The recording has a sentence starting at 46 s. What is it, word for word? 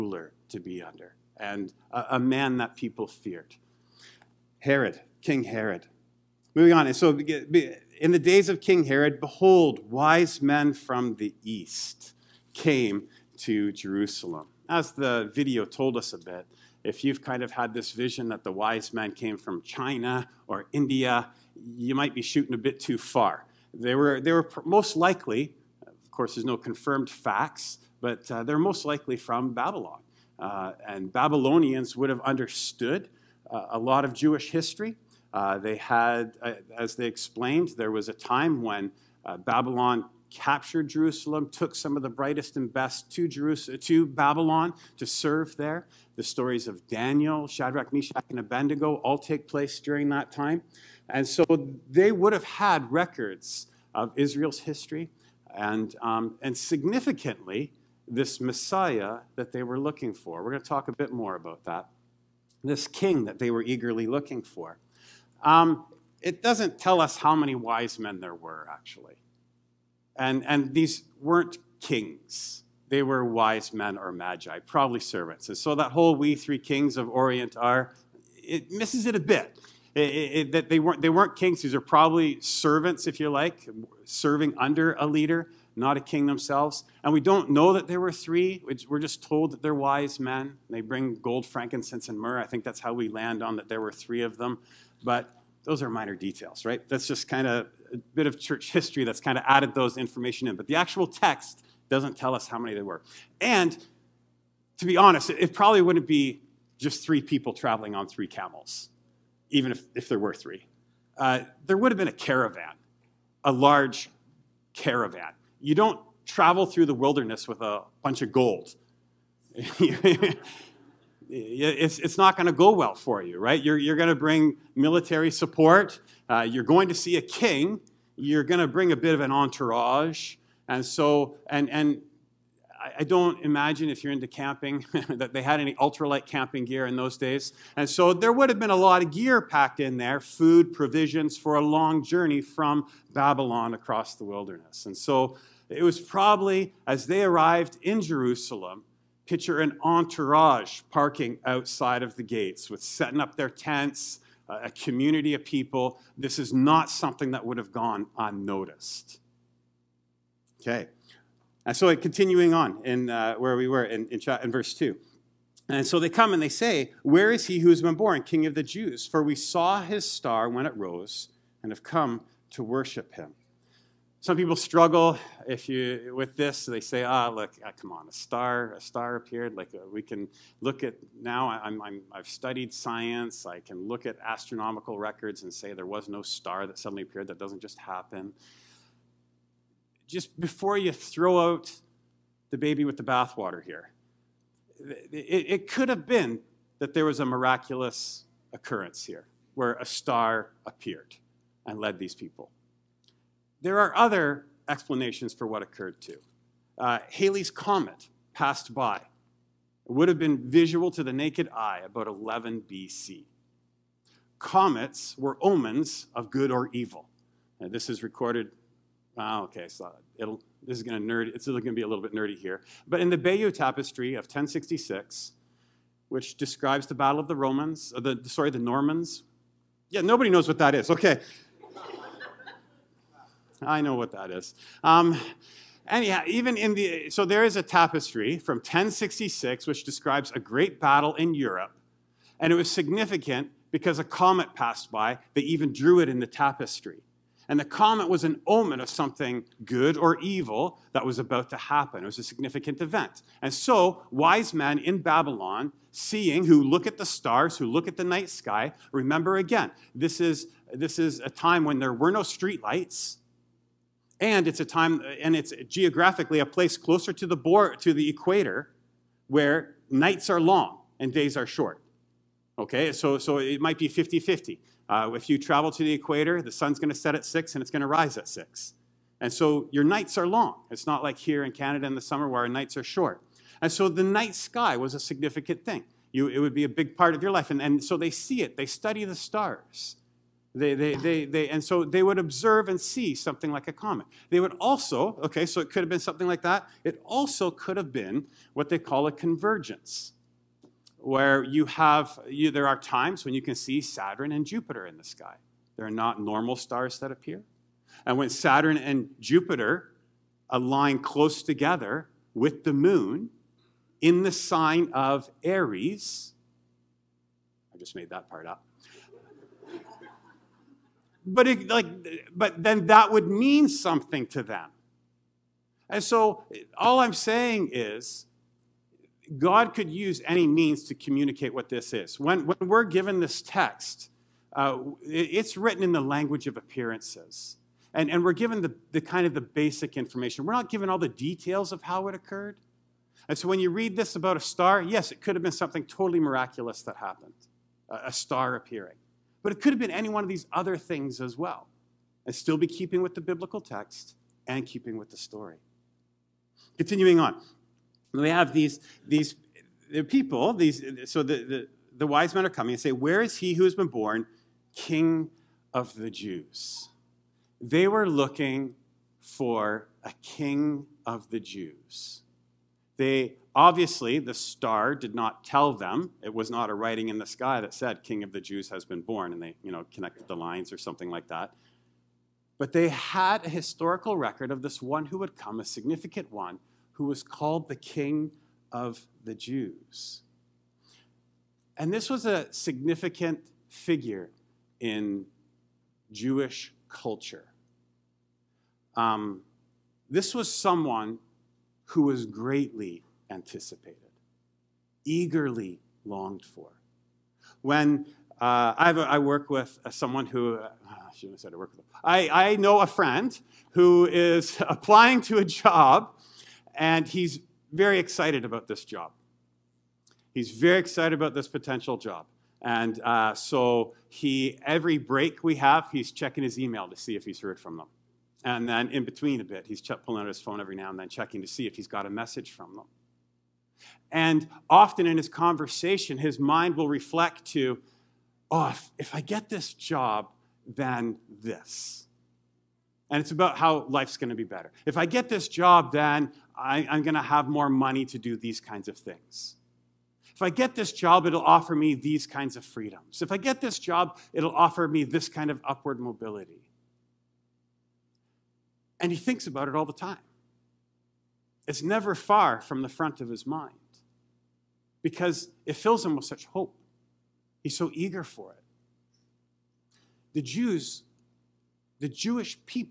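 The stories of Daniel, Shadrach, Meshach, and Abednego all take place during that time.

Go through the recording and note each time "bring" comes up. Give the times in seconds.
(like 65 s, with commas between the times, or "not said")
90 s, 124 s, 128 s.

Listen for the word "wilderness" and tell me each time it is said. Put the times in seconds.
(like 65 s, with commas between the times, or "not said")
116 s, 144 s.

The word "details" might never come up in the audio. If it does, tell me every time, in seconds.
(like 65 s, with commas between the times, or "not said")
96 s, 341 s.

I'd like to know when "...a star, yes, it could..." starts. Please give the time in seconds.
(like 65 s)
344 s.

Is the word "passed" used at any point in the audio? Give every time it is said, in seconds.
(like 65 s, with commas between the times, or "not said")
208 s, 244 s.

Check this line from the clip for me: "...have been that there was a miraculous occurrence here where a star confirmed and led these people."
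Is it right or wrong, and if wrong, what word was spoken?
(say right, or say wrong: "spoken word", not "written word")
wrong: "appeared", not "confirmed".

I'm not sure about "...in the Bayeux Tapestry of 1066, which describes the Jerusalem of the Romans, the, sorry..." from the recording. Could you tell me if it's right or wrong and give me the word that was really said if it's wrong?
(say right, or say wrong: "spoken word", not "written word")
wrong: "Battle", not "Jerusalem".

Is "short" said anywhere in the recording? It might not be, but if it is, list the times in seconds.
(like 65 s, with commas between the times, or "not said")
271 s, 282 s.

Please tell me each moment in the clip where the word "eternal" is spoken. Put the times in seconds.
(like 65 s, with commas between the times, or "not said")
not said.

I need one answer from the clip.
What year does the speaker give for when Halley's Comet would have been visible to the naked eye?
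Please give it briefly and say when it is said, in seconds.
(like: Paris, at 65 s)
11 BC, at 212 s.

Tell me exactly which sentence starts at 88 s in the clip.
We're just told that they're wise men.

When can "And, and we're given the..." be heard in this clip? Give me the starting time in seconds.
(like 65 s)
337 s.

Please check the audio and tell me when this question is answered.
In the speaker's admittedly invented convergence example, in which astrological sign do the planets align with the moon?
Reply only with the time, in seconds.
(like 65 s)
315 s.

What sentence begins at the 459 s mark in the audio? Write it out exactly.
And he thinks about it all the time.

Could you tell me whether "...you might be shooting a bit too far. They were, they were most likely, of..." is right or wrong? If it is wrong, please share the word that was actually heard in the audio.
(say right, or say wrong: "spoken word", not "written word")
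right.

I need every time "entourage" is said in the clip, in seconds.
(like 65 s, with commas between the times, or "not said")
129 s, 149 s.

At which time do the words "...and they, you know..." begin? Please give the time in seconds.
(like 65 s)
379 s.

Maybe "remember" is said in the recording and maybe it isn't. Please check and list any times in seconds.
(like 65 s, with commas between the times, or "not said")
258 s.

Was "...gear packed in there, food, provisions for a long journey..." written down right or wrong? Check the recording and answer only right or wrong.
right.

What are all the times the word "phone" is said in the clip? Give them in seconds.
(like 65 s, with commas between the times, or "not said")
430 s.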